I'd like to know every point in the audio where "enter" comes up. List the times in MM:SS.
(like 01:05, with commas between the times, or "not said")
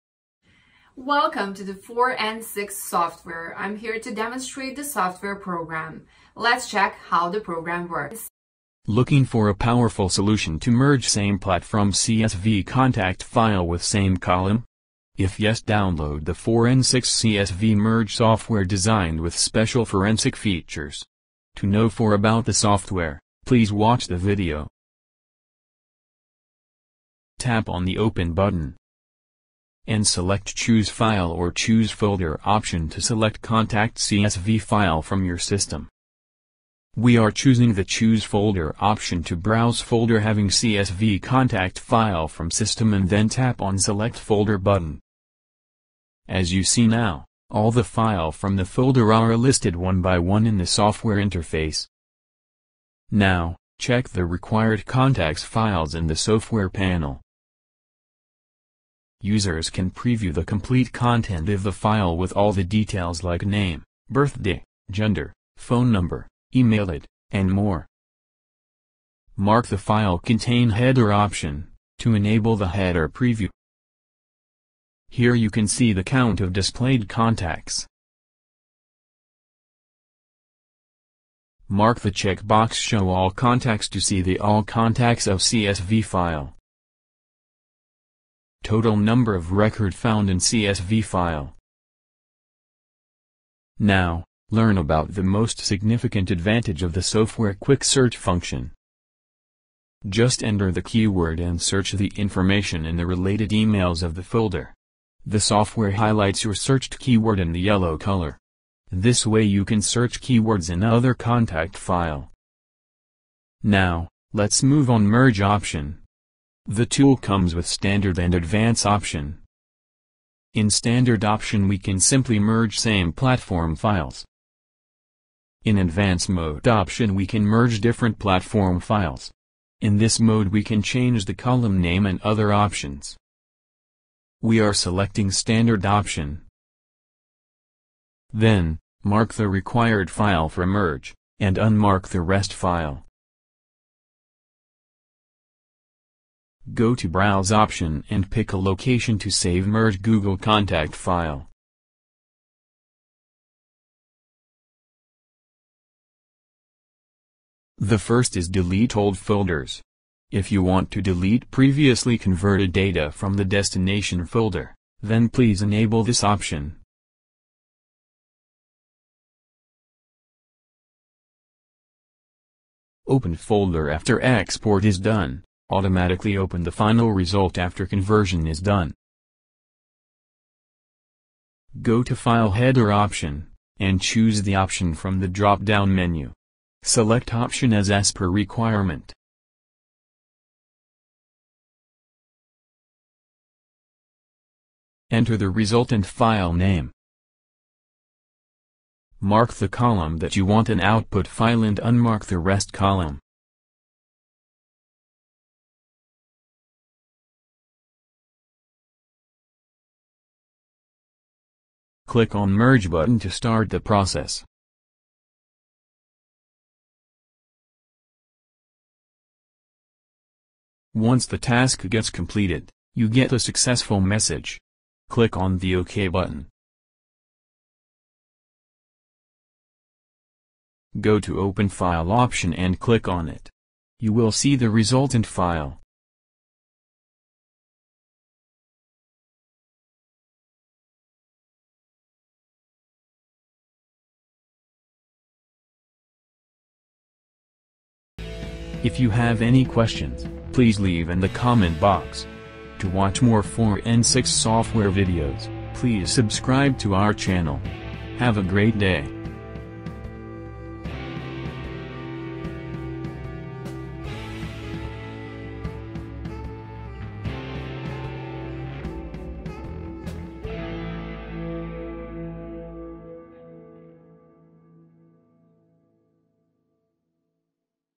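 01:40, 03:15.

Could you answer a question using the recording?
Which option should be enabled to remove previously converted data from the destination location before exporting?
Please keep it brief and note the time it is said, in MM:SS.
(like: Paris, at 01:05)
Delete old folders, at 02:38.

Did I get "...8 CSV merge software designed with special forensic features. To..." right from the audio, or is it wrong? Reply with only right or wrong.
wrong.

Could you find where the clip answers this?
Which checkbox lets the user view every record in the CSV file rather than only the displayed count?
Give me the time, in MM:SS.
01:22.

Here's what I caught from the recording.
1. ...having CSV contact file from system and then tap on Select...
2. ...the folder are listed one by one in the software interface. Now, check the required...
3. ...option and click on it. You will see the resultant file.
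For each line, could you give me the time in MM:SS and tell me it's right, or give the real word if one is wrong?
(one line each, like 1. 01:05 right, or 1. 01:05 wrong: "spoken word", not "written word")
1. 00:40 right
2. 00:48 right
3. 03:52 right.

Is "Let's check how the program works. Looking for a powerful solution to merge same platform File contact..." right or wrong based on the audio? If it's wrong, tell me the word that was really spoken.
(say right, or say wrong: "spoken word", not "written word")
wrong: "CSV", not "File".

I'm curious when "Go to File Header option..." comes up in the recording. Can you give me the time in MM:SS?
03:01.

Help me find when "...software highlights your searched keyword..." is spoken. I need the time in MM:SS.
01:45.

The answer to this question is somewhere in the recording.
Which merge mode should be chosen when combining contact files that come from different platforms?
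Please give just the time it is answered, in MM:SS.
02:05.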